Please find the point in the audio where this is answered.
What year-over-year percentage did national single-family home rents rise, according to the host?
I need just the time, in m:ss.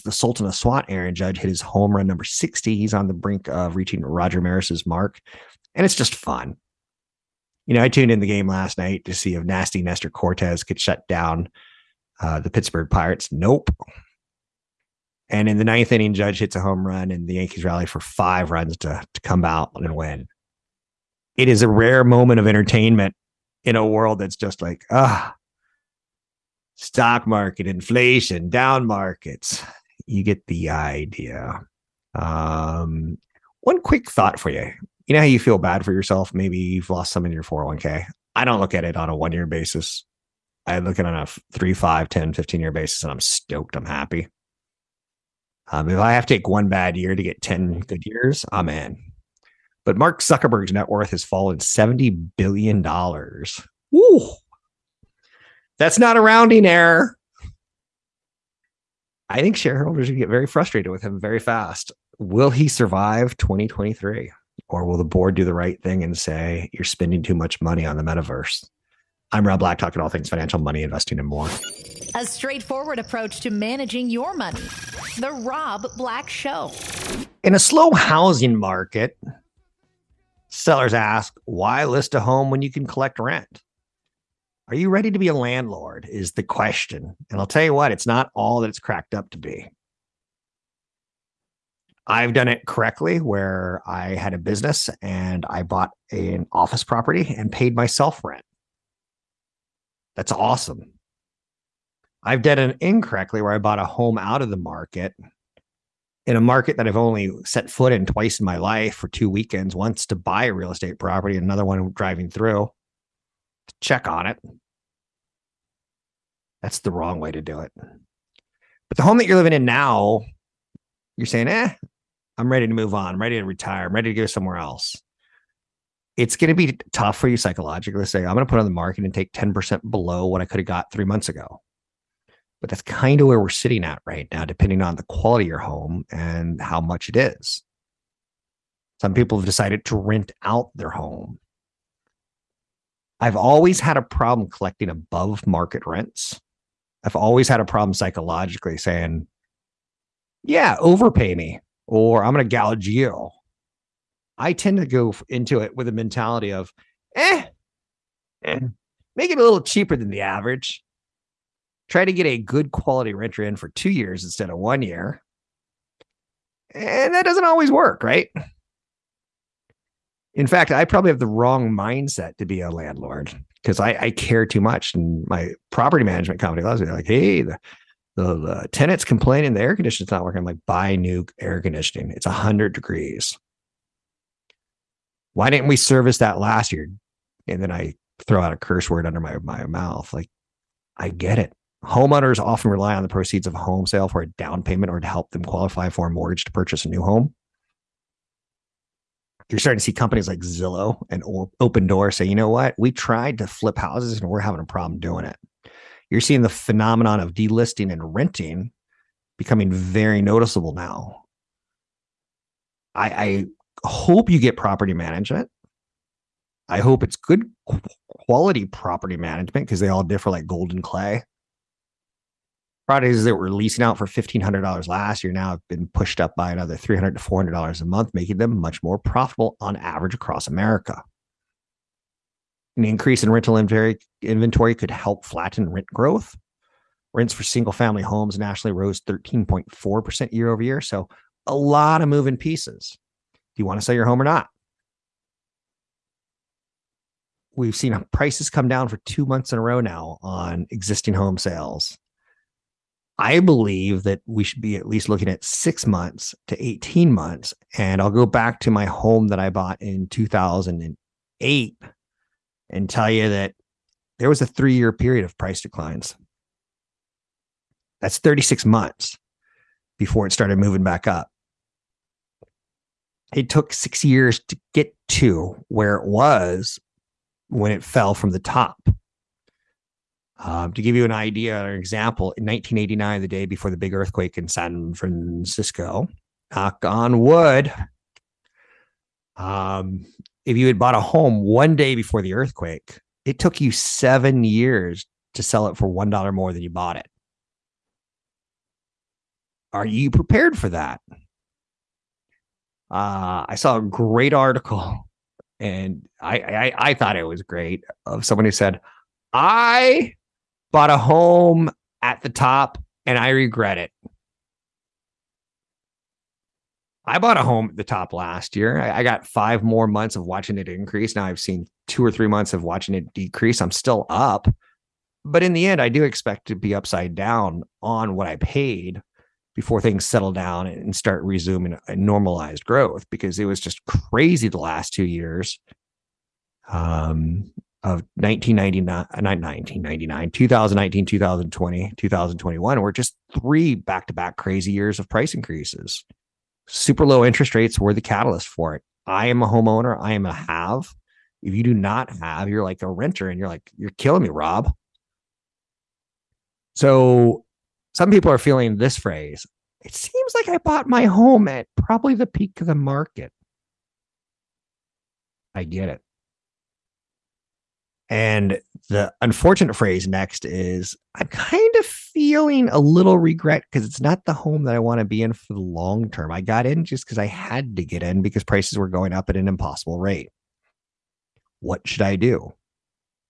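3:59.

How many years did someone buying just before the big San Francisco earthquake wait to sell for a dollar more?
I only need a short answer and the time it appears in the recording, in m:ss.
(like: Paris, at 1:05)
7 years, at 4:53.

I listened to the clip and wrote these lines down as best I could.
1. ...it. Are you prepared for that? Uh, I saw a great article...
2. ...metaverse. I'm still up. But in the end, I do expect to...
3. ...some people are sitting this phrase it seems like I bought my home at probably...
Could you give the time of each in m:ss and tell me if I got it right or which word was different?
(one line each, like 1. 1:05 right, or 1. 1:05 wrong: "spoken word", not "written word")
1. 4:56 right
2. 5:23 wrong: "decrease", not "metaverse"
3. 5:57 wrong: "feeling", not "sitting".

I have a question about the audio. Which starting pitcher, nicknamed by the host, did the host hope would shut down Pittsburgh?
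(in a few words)
Nestor Cortes.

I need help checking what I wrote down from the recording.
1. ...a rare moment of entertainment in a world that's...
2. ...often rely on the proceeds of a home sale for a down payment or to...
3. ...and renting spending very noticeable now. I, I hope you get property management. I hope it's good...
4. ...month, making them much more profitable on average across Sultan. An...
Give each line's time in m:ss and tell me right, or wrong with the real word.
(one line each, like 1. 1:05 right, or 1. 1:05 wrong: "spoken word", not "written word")
1. 0:21 right
2. 3:12 right
3. 3:27 wrong: "becoming", not "spending"
4. 3:47 wrong: "America", not "Sultan".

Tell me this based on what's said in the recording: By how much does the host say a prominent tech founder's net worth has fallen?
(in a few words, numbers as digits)
$70 billion.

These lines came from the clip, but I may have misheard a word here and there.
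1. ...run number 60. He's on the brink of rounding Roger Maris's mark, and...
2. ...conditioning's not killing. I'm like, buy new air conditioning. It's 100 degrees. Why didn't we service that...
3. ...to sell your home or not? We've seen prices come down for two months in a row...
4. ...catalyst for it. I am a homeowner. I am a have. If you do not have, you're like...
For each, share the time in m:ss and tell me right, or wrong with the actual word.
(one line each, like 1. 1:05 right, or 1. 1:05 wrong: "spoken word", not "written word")
1. 0:01 wrong: "reaching", not "rounding"
2. 2:59 wrong: "working", not "killing"
3. 4:03 right
4. 5:48 right.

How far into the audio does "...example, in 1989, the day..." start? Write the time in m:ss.
4:41.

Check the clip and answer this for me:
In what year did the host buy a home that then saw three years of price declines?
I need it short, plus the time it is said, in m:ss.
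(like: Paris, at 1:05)
2008, at 4:20.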